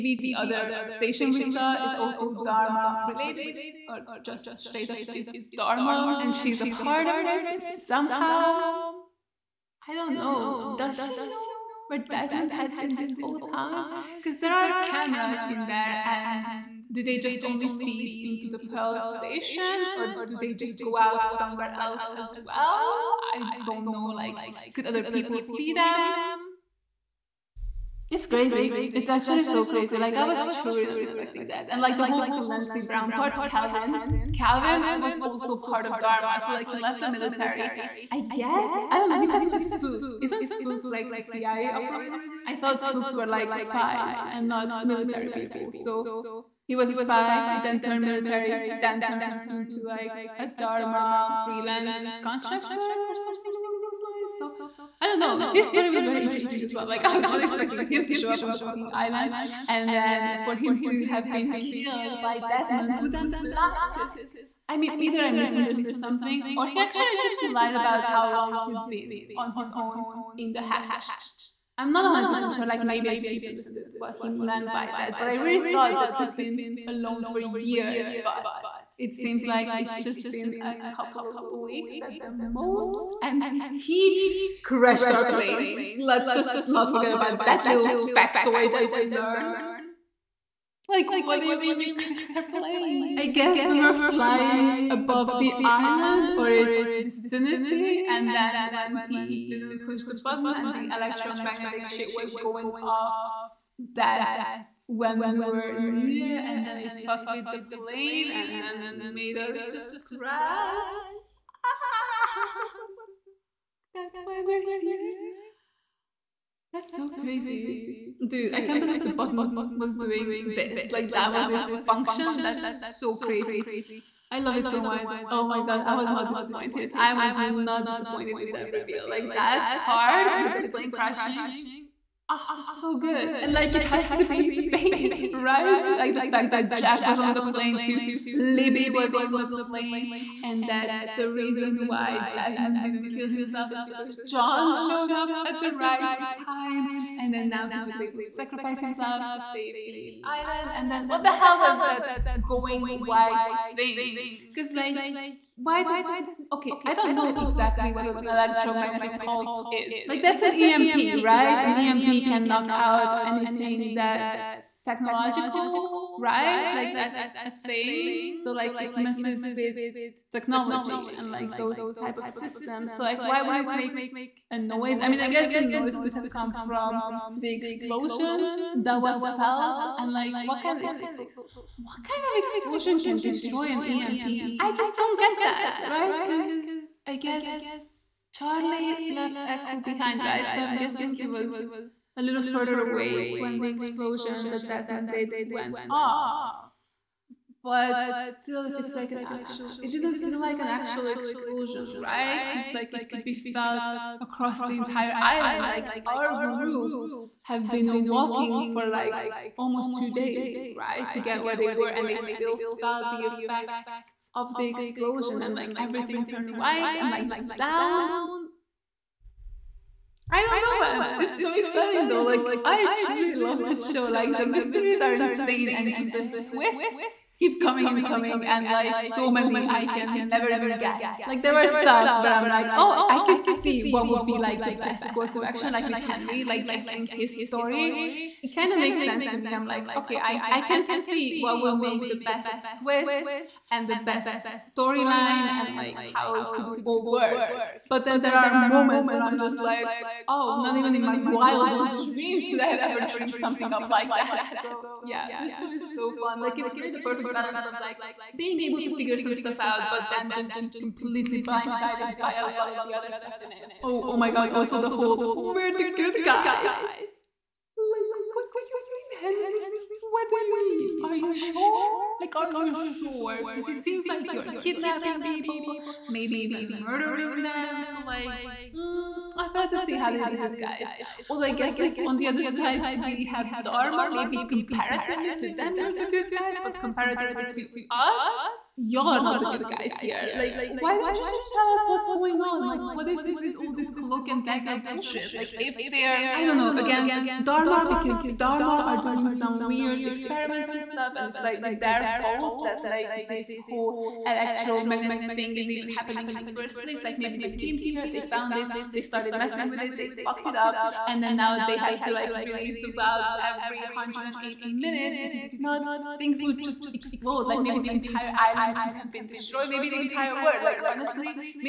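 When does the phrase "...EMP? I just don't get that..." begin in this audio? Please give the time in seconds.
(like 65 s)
183 s.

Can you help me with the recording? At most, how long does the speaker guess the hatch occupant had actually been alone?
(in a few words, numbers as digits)
a couple of weeks.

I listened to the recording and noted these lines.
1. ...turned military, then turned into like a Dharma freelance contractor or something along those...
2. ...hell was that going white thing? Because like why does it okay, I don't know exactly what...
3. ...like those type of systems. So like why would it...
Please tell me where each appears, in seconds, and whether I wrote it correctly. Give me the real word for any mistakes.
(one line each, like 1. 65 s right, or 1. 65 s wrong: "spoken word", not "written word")
1. 47 s right
2. 151 s right
3. 171 s right.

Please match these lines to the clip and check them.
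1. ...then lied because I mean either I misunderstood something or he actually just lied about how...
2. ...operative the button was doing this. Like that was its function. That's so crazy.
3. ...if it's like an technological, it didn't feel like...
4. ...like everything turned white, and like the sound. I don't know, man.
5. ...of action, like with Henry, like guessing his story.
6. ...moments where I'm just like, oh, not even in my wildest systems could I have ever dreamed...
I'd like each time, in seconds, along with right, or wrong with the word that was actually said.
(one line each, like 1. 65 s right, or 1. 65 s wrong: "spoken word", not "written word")
1. 63 s right
2. 118 s wrong: "believe", not "operative"
3. 198 s wrong: "actual", not "technological"
4. 215 s right
5. 235 s right
6. 248 s wrong: "dreams", not "systems".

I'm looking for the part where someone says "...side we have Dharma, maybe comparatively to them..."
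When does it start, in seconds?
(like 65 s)
282 s.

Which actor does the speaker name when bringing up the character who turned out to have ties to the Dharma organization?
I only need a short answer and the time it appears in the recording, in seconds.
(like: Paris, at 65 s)
Clancy Brown, at 32 s.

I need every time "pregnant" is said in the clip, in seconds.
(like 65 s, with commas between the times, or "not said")
not said.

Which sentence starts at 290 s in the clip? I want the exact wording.
Like, why don't you just tell us what's going on?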